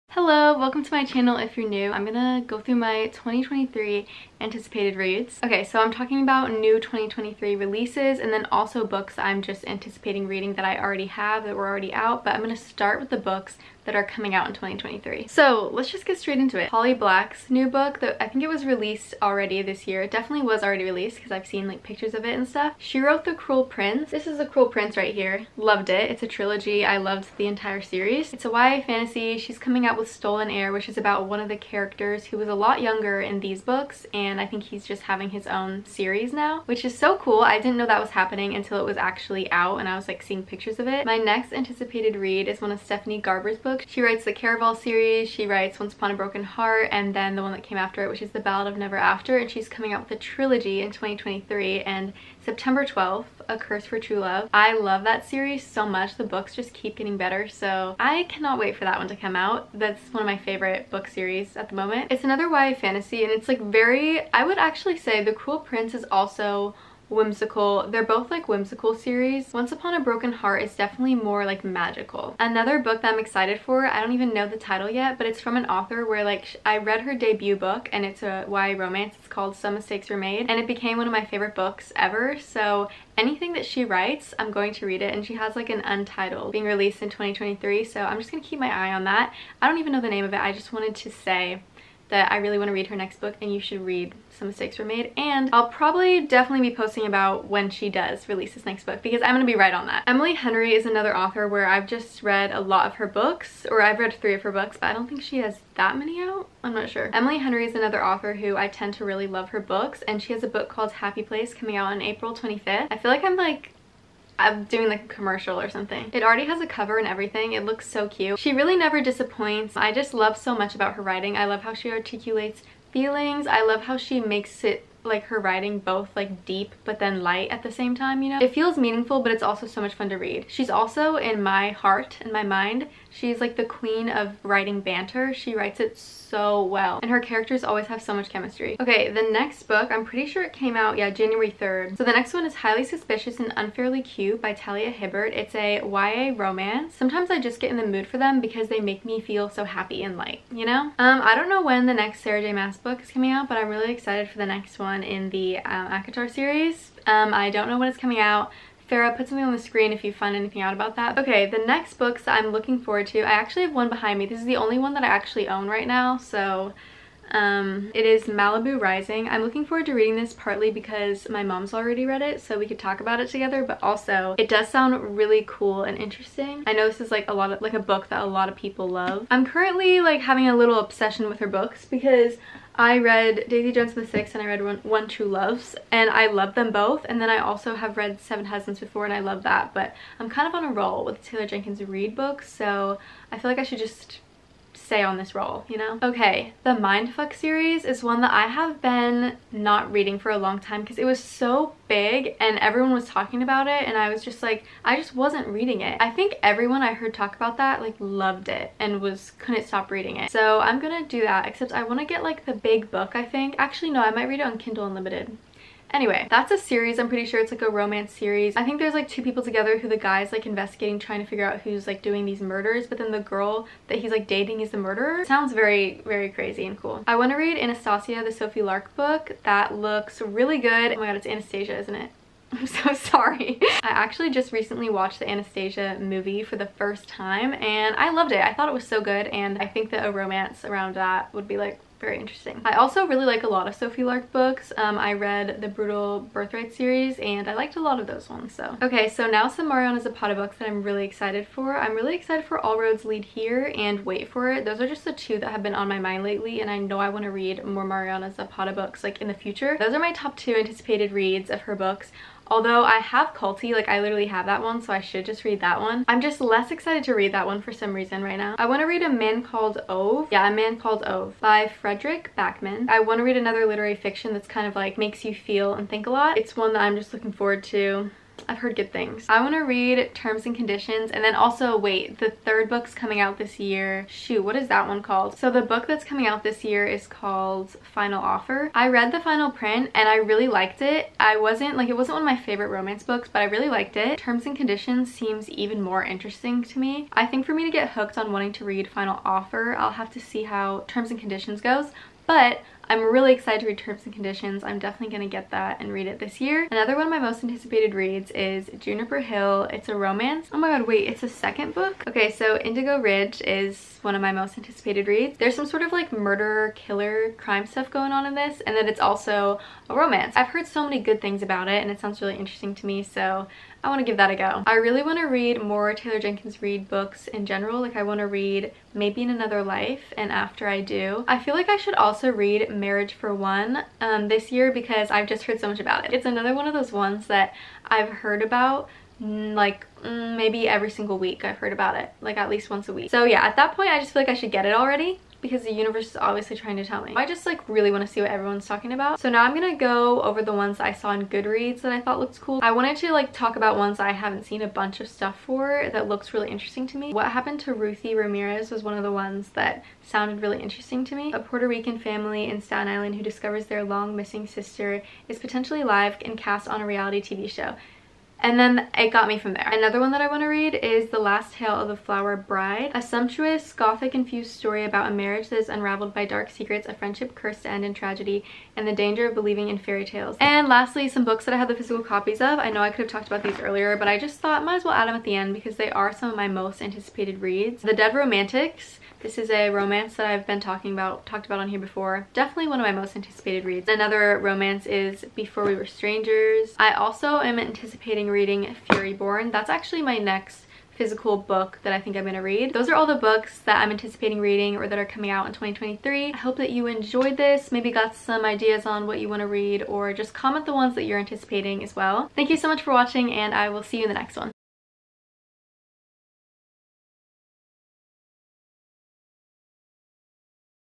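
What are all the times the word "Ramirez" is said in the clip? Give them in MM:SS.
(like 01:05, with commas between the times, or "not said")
05:58.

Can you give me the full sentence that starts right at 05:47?
I just like really want to see what everyone's talking about.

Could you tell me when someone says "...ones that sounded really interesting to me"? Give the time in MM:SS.
05:59.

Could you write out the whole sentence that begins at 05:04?
I'm definitely going to get that and read it this year.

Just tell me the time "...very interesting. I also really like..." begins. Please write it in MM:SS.
04:02.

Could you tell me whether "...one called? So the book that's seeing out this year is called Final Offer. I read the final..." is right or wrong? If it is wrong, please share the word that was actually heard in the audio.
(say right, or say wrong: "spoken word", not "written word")
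wrong: "coming", not "seeing".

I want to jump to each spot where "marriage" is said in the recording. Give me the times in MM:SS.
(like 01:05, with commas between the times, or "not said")
05:32, 06:15.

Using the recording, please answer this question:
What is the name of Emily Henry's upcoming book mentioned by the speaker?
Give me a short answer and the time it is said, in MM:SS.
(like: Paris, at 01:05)
Happy Place, at 01:50.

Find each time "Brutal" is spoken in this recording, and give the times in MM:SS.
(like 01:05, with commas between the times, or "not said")
04:05.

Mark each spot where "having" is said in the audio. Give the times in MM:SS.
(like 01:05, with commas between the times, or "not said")
00:35, 03:00.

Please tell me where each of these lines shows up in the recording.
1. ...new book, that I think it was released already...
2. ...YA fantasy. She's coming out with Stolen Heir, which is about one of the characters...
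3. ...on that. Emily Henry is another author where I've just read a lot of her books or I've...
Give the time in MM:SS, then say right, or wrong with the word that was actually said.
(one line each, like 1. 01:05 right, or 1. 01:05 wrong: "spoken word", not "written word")
1. 00:17 right
2. 00:28 right
3. 01:39 right.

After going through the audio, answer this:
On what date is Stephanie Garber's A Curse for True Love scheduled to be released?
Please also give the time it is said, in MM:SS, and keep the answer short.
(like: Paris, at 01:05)
September 12, at 00:52.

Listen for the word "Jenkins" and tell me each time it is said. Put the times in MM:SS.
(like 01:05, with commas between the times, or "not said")
03:11, 05:26.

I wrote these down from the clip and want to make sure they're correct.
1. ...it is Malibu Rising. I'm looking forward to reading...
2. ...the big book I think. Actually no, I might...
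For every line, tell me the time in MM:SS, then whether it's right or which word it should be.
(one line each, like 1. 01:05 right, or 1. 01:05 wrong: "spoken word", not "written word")
1. 02:47 right
2. 03:32 right.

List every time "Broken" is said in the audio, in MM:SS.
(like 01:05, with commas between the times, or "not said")
00:46, 01:09.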